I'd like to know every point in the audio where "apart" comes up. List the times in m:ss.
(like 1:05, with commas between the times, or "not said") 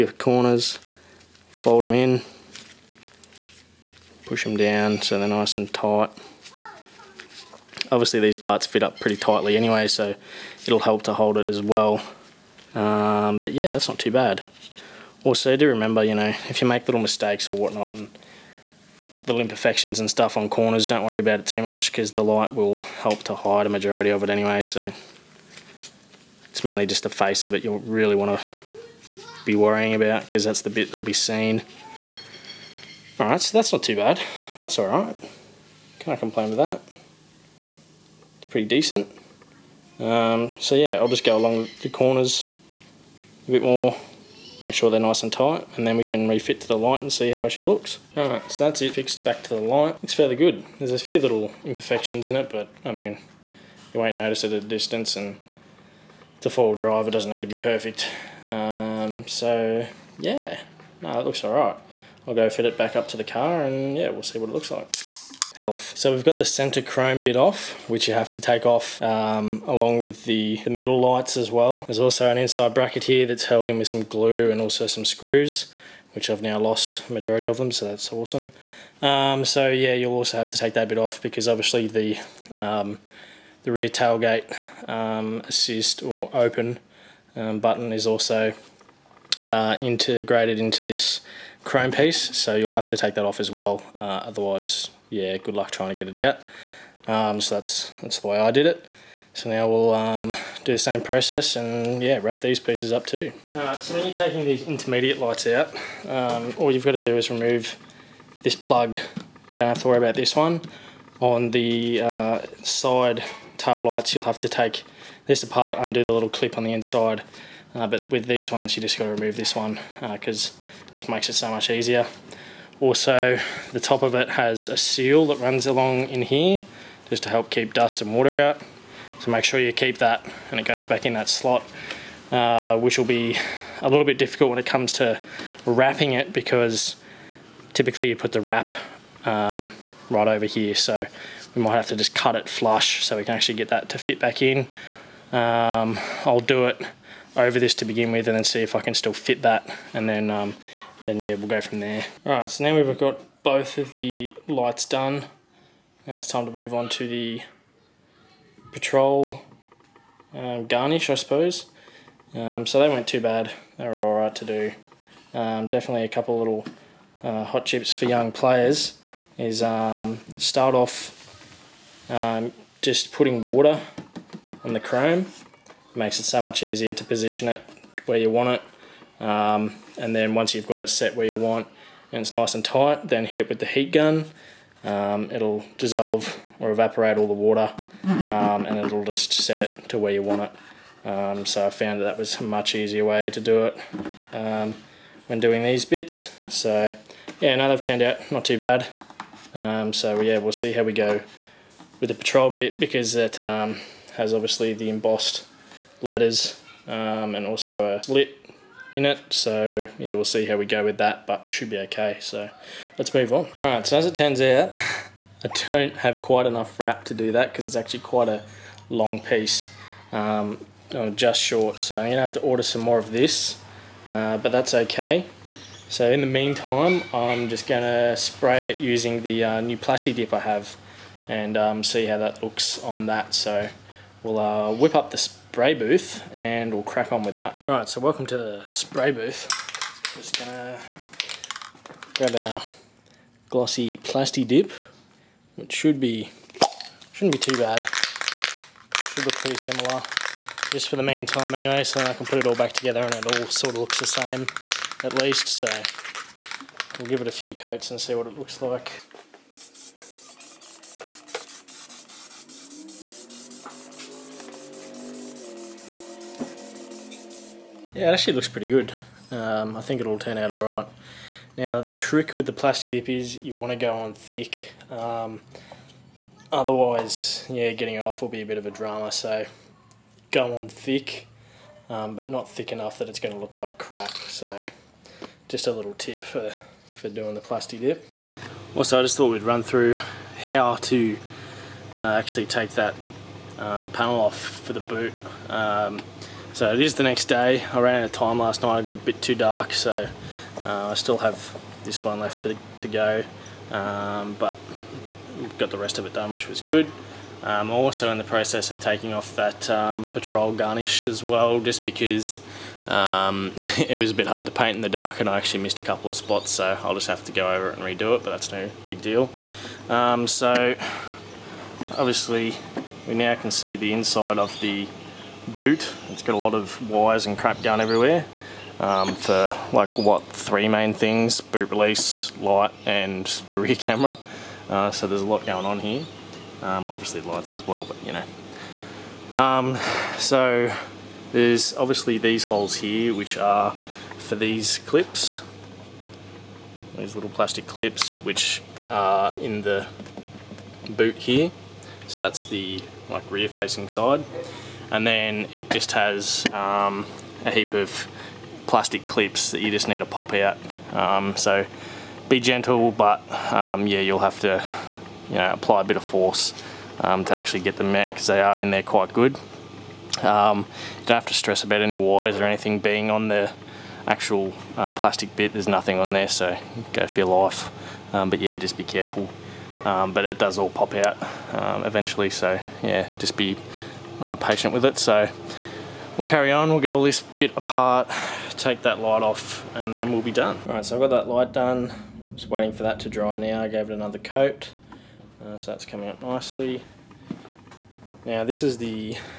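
1:55, 6:27.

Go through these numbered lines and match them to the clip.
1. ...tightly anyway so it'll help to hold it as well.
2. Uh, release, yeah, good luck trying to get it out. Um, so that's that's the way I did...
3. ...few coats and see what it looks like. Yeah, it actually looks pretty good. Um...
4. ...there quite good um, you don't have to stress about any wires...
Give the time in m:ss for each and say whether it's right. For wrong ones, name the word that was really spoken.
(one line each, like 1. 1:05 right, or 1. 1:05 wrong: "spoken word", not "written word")
1. 0:09 right
2. 1:33 wrong: "otherwise", not "release"
3. 4:17 right
4. 6:08 right.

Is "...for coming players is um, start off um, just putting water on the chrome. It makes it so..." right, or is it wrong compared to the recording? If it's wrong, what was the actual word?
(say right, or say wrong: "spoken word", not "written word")
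wrong: "young", not "coming".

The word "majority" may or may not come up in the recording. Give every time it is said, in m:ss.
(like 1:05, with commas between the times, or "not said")
0:23, 1:17.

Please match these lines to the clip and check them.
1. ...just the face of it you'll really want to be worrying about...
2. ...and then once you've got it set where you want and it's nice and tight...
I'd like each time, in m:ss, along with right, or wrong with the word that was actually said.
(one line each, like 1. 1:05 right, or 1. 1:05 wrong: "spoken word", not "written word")
1. 0:26 right
2. 2:59 right.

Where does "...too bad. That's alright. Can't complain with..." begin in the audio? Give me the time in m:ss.
0:33.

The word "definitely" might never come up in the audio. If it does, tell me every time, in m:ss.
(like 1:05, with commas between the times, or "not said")
2:45.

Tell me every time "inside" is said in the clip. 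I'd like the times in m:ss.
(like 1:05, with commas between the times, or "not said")
1:12, 1:56, 5:23.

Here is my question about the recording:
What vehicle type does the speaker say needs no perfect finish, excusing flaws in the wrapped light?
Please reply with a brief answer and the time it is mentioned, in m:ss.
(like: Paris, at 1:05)
four-wheel drive, at 0:56.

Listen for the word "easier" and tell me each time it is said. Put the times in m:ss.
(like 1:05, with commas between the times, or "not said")
2:01, 2:56, 3:12.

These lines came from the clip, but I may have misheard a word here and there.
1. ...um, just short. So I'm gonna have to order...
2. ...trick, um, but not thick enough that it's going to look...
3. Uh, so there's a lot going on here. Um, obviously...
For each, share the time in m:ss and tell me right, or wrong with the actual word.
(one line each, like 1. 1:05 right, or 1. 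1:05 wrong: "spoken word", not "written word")
1. 3:40 right
2. 4:40 wrong: "thick", not "trick"
3. 5:34 right.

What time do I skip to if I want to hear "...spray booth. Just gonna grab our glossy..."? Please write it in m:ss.
3:58.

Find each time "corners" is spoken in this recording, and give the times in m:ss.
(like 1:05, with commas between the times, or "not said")
0:00, 0:20, 0:41.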